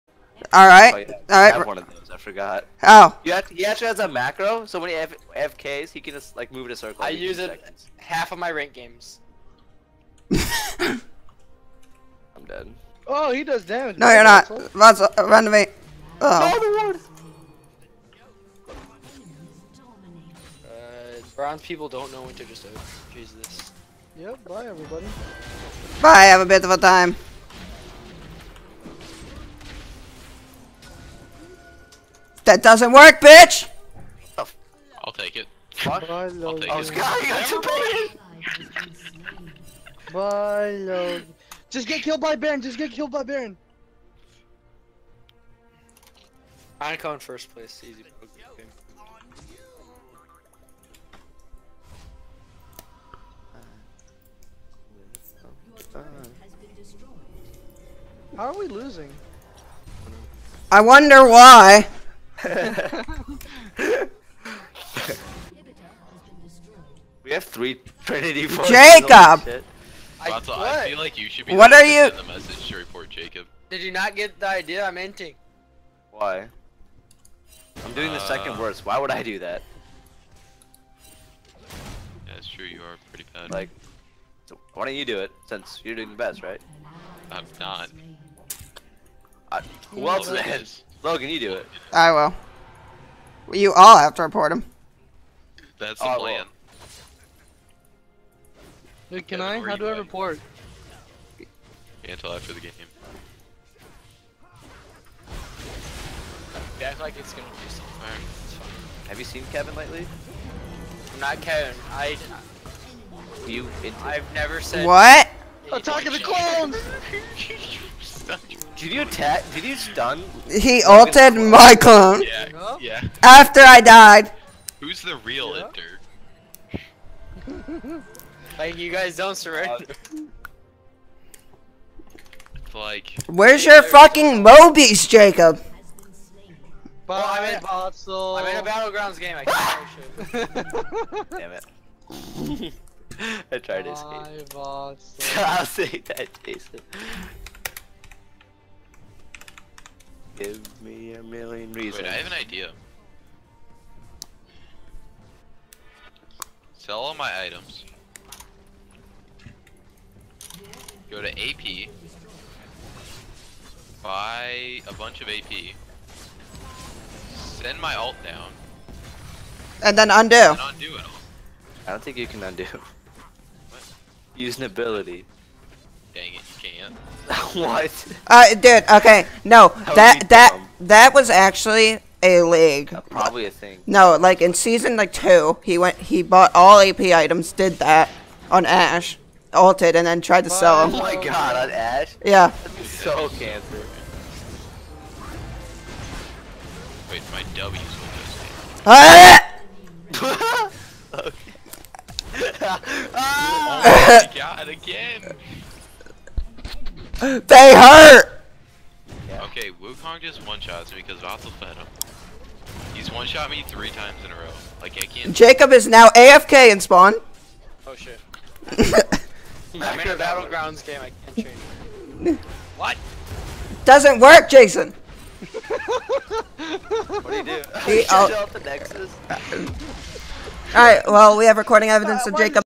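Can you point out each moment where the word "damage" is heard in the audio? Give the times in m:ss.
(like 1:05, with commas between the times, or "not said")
0:13.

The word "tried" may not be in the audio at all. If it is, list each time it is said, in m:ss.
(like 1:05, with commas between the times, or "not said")
2:23, 3:10.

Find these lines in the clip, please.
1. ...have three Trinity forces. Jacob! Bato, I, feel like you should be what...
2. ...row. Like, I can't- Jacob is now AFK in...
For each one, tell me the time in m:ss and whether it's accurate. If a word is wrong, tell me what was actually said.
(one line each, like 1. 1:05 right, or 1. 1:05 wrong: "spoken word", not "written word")
1. 1:07 right
2. 3:34 right.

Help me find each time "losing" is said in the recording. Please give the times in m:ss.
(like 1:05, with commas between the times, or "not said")
0:58.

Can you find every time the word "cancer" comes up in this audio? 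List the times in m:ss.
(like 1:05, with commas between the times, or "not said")
3:13.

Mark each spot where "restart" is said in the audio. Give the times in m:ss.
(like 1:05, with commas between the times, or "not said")
not said.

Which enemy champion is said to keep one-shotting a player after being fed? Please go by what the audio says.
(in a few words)
Wukong.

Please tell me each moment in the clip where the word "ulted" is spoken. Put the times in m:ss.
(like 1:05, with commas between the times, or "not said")
2:00.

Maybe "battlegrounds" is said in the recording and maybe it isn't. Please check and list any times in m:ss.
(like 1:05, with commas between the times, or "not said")
2:18, 3:40.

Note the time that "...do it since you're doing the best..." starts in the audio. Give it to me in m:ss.
1:25.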